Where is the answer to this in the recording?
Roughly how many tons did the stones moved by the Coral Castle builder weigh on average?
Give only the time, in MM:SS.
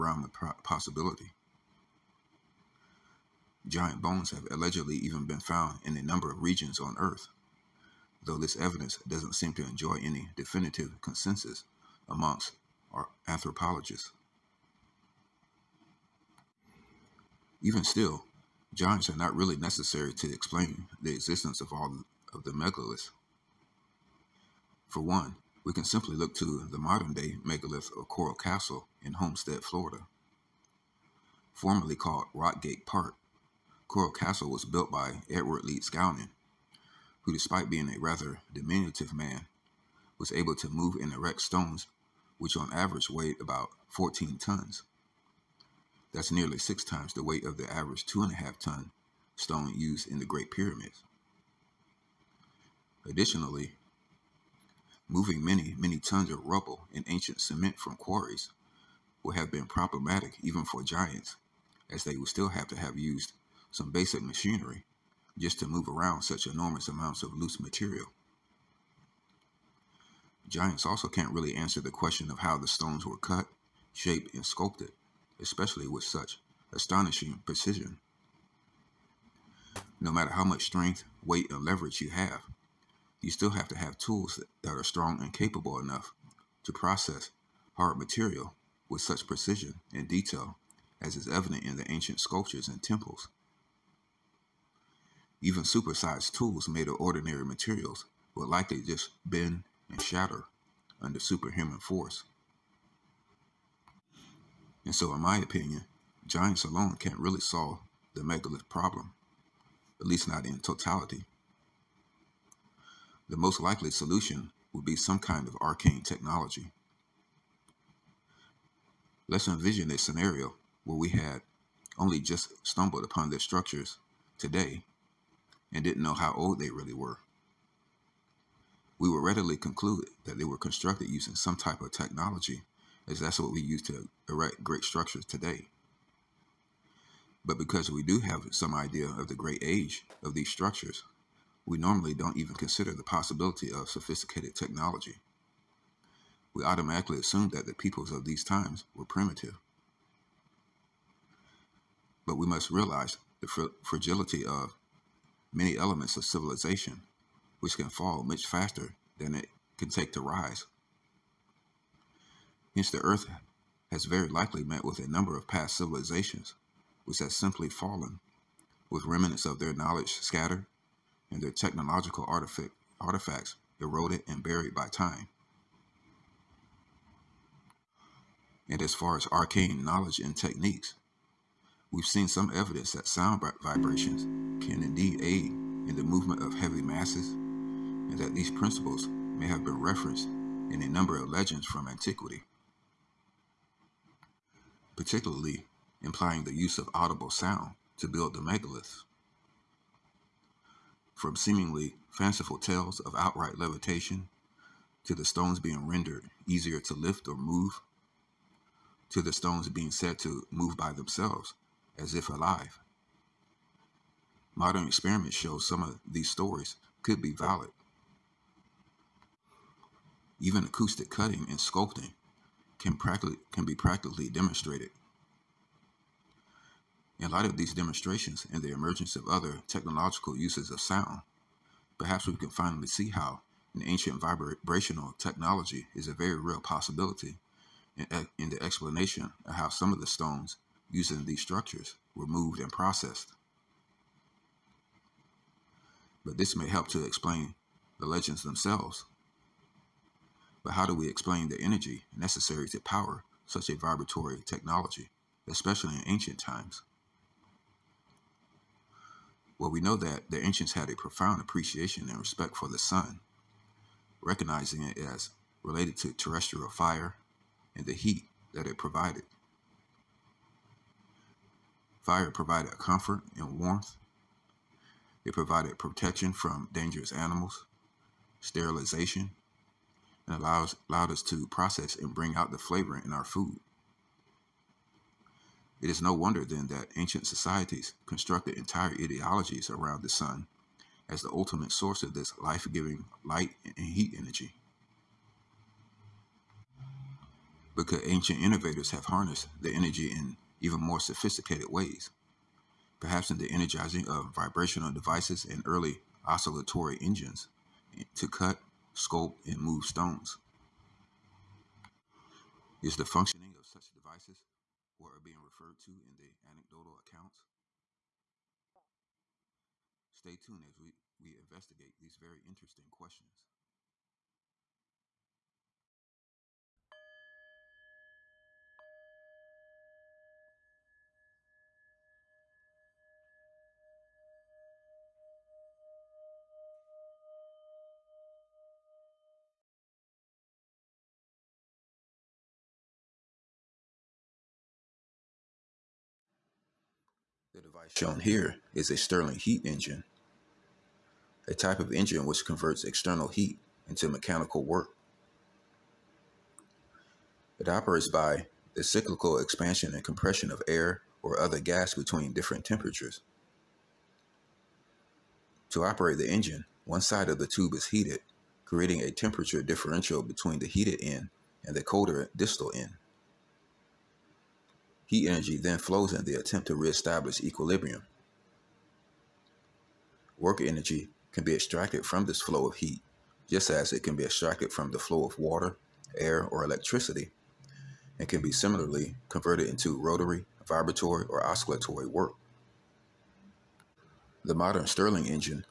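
00:43.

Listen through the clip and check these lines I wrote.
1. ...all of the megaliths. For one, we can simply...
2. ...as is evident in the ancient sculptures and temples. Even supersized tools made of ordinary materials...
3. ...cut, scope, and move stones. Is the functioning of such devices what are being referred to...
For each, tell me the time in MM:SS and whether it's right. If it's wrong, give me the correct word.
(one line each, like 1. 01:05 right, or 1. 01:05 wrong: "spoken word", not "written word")
1. 00:21 right
2. 01:31 right
3. 05:08 right.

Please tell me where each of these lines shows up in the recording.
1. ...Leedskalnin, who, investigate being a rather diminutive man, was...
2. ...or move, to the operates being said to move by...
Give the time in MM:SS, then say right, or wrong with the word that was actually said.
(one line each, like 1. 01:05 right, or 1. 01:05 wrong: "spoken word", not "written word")
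1. 00:35 wrong: "despite", not "investigate"
2. 03:27 wrong: "stones", not "operates".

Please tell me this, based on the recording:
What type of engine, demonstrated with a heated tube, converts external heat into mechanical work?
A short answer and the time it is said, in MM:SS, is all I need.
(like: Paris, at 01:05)
Stirling heat engine, at 05:48.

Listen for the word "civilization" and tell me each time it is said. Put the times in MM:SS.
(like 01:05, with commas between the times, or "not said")
02:36, 02:45.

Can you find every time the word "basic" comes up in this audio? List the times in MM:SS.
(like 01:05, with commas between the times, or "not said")
01:03.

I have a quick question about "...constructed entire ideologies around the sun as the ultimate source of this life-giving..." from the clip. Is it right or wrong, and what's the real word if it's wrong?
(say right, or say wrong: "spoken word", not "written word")
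right.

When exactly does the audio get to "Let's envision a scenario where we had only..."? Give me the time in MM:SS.
01:59.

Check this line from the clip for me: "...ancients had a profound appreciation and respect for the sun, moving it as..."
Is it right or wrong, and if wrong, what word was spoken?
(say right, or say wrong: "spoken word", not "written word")
wrong: "recognizing", not "moving".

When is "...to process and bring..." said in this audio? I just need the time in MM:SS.
04:41.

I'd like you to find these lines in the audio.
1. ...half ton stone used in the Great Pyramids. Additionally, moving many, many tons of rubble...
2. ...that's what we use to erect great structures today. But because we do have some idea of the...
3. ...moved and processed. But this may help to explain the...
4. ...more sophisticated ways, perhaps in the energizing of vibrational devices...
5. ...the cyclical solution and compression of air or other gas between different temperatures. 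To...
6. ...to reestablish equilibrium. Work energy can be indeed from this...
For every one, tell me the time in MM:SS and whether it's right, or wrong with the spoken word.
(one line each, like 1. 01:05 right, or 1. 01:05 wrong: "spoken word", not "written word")
1. 00:48 right
2. 02:13 right
3. 04:02 right
4. 05:00 right
5. 05:58 wrong: "expansion", not "solution"
6. 06:16 wrong: "extracted", not "indeed".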